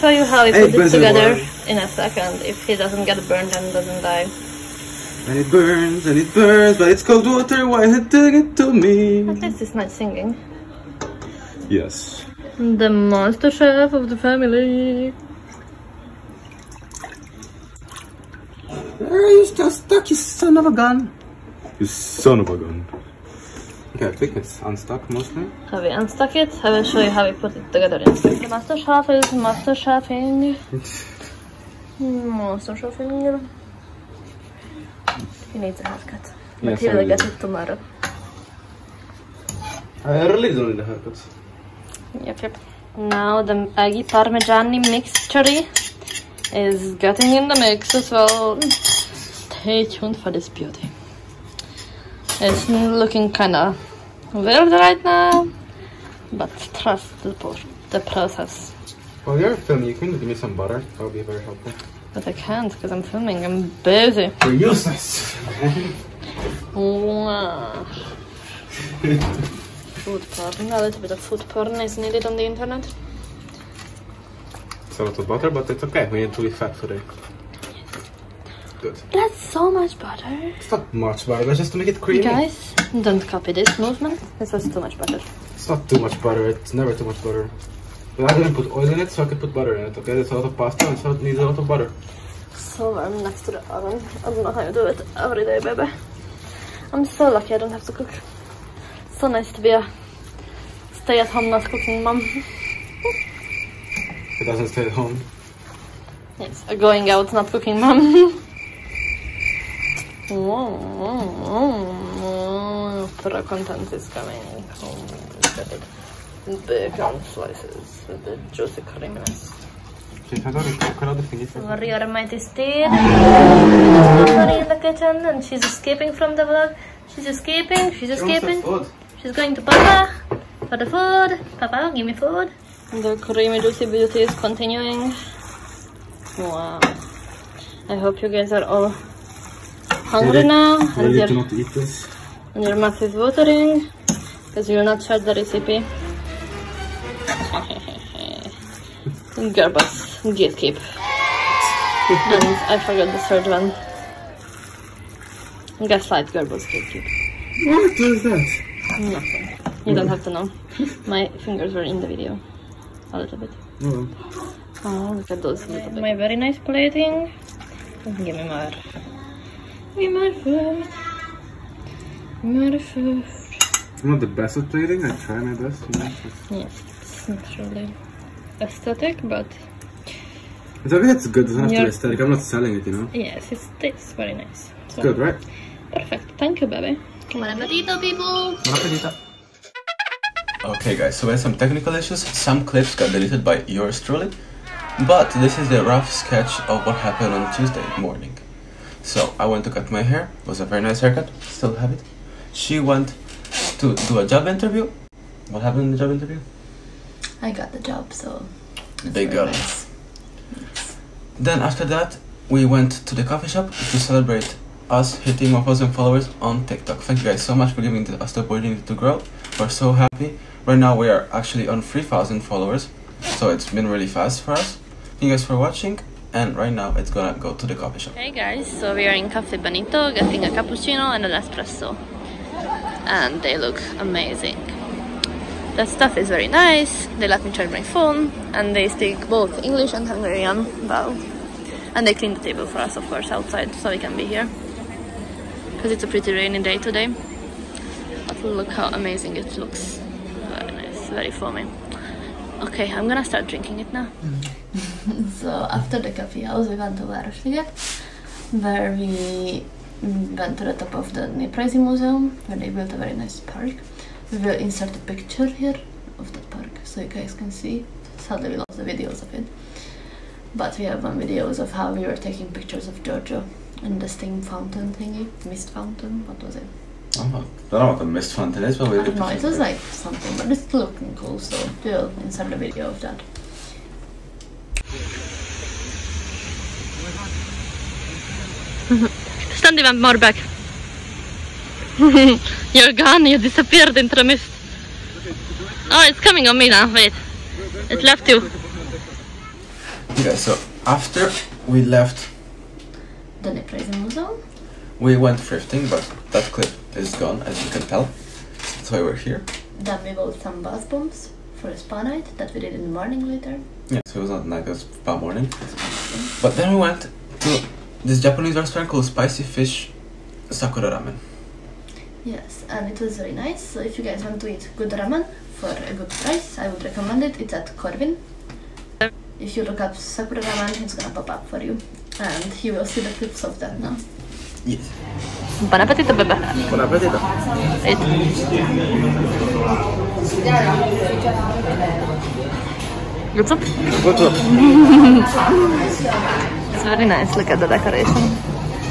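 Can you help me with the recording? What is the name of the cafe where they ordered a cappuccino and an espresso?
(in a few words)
Cafe Benito.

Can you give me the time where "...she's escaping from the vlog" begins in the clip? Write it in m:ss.
2:05.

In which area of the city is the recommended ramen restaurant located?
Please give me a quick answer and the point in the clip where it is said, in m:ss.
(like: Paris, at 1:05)
Corvin, at 5:27.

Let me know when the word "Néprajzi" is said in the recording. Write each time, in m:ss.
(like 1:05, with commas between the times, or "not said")
4:21, 5:03.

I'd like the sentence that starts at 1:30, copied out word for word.
There's a lot of pasta, and so it needs a lot of butter.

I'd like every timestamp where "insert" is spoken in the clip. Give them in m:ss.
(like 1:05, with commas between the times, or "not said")
4:24, 4:42.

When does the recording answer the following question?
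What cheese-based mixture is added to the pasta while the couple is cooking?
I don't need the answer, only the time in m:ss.
0:43.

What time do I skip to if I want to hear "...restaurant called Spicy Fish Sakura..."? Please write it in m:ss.
5:18.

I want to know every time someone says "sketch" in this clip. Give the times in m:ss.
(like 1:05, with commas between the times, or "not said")
3:16.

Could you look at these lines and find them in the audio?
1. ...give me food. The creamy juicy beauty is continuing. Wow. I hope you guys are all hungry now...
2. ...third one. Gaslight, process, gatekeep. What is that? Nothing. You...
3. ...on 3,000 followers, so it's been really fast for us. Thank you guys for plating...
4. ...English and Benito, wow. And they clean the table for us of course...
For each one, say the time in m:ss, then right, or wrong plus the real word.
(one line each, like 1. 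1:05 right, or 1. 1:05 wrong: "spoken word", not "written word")
1. 2:11 right
2. 2:33 wrong: "girlboss", not "process"
3. 3:41 wrong: "watching", not "plating"
4. 3:59 wrong: "Hungarian", not "Benito".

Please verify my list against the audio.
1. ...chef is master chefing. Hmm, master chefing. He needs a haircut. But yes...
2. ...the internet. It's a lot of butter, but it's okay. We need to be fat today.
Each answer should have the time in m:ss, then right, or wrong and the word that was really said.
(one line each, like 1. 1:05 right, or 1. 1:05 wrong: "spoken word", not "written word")
1. 0:28 right
2. 1:12 right.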